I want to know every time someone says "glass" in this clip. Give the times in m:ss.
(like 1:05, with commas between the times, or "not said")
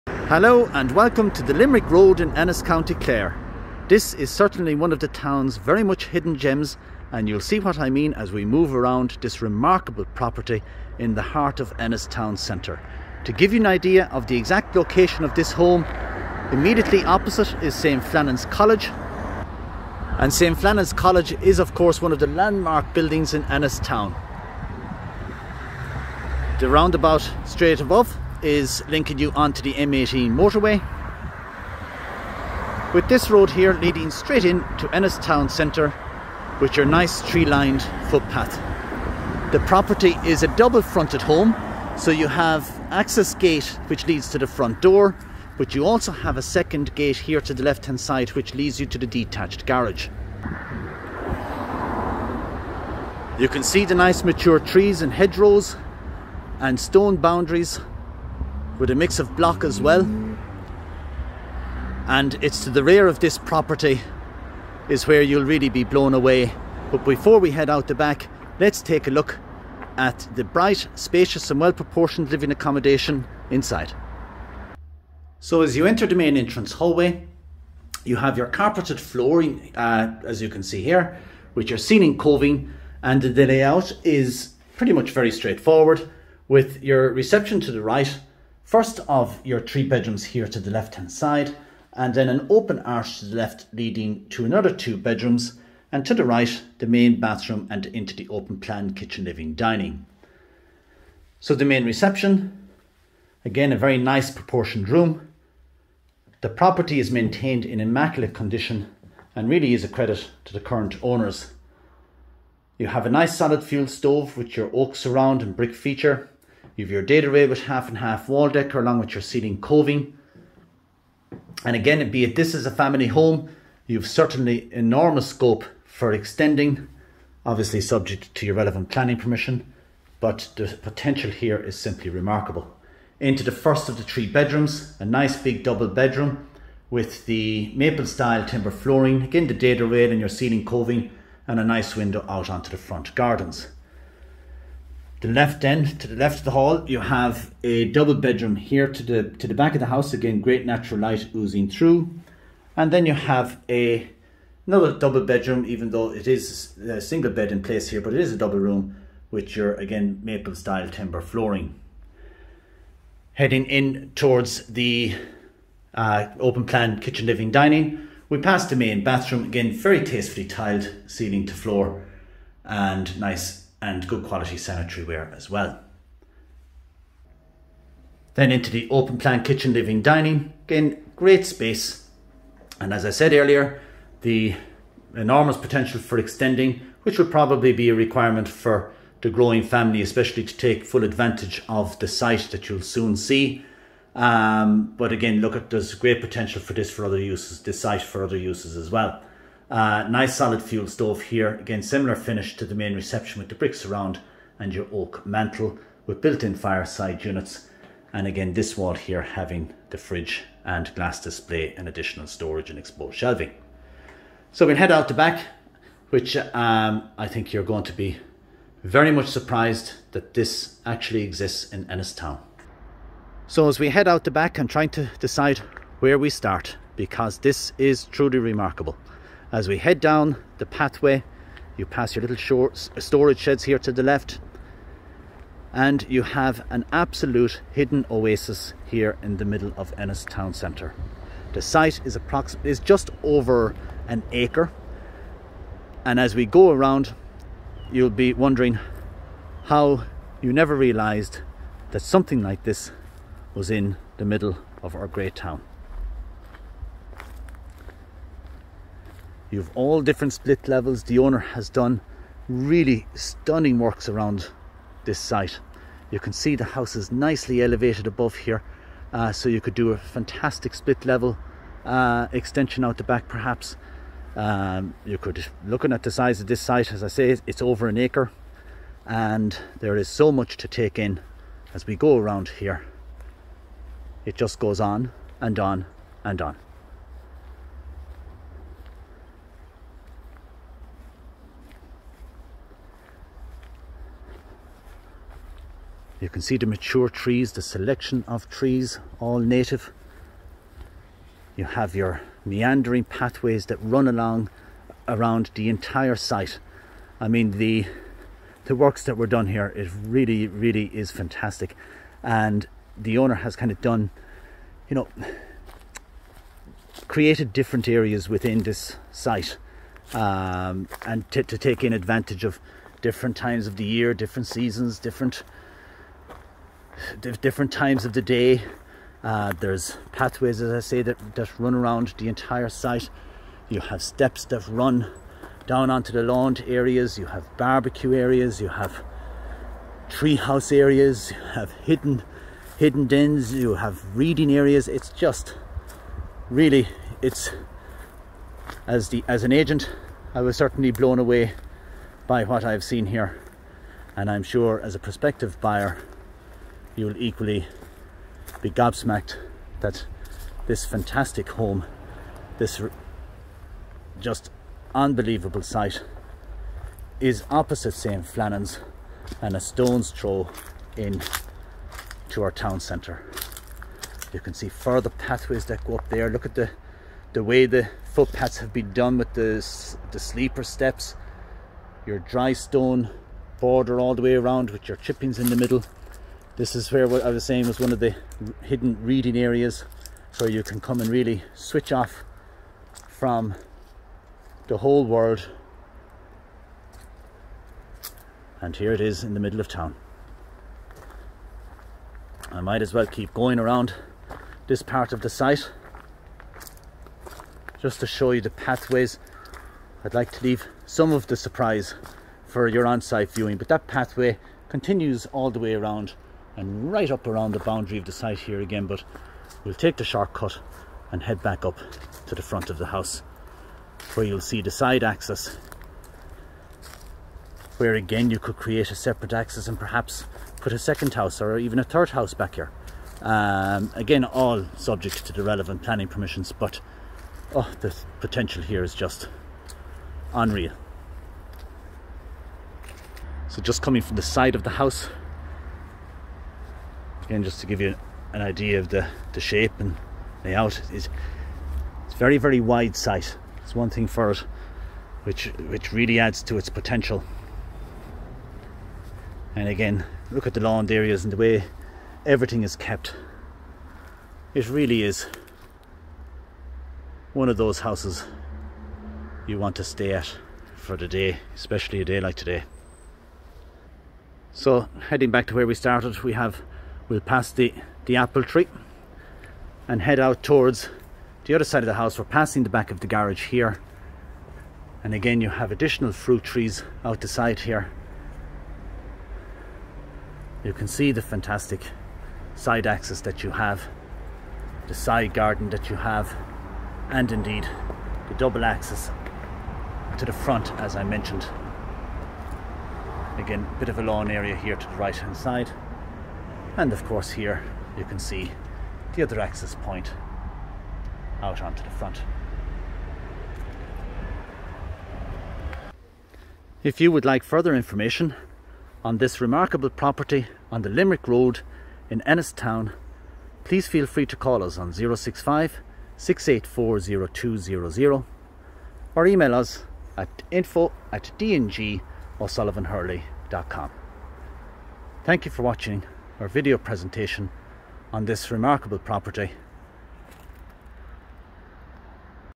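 3:30.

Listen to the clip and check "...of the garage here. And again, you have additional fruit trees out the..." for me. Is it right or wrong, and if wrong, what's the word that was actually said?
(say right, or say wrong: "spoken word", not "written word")
right.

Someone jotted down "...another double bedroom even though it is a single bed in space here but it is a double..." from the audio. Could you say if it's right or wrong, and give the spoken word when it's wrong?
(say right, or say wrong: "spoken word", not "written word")
wrong: "place", not "space".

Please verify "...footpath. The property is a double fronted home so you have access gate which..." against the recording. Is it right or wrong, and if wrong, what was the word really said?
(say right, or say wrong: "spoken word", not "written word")
right.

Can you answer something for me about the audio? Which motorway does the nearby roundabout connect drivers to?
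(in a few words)
M18.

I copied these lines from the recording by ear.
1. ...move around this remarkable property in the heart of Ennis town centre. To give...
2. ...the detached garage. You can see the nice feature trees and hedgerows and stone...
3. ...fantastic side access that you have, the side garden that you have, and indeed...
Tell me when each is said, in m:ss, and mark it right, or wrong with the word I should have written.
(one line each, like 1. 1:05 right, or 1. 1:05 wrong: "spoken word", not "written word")
1. 0:08 right
2. 0:48 wrong: "mature", not "feature"
3. 8:11 right.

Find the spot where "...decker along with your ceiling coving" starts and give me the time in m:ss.
1:58.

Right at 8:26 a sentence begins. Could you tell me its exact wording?
And of course here you can see the other access point out onto the front.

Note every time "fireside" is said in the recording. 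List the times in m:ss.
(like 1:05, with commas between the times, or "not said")
3:26.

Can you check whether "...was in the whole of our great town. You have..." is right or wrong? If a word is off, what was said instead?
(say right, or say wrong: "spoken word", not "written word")
wrong: "middle", not "whole".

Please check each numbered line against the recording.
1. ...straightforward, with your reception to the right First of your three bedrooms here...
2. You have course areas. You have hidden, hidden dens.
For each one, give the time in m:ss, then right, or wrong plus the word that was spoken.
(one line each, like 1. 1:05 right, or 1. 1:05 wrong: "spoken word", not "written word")
1. 1:25 right
2. 5:38 wrong: "treehouse", not "course".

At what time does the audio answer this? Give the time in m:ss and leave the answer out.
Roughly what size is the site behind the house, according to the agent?
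4:02.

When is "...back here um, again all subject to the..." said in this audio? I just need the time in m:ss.
7:12.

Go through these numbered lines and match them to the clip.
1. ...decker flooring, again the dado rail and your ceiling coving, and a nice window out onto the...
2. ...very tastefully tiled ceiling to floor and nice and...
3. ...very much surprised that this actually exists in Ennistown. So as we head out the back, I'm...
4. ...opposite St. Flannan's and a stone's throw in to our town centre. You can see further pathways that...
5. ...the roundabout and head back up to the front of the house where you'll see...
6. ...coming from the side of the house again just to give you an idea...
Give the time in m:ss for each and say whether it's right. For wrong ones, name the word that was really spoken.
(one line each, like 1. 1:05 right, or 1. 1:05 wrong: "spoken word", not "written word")
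1. 2:18 wrong: "timber", not "decker"
2. 2:49 right
3. 3:38 right
4. 6:07 right
5. 6:59 wrong: "shortcut", not "roundabout"
6. 7:23 right.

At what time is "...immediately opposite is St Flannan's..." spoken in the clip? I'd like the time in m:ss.
0:16.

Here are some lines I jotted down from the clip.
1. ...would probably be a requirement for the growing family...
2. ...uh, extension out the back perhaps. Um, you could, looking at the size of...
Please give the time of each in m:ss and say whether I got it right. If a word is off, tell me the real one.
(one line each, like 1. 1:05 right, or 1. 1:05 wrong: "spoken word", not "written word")
1. 3:07 right
2. 4:31 right.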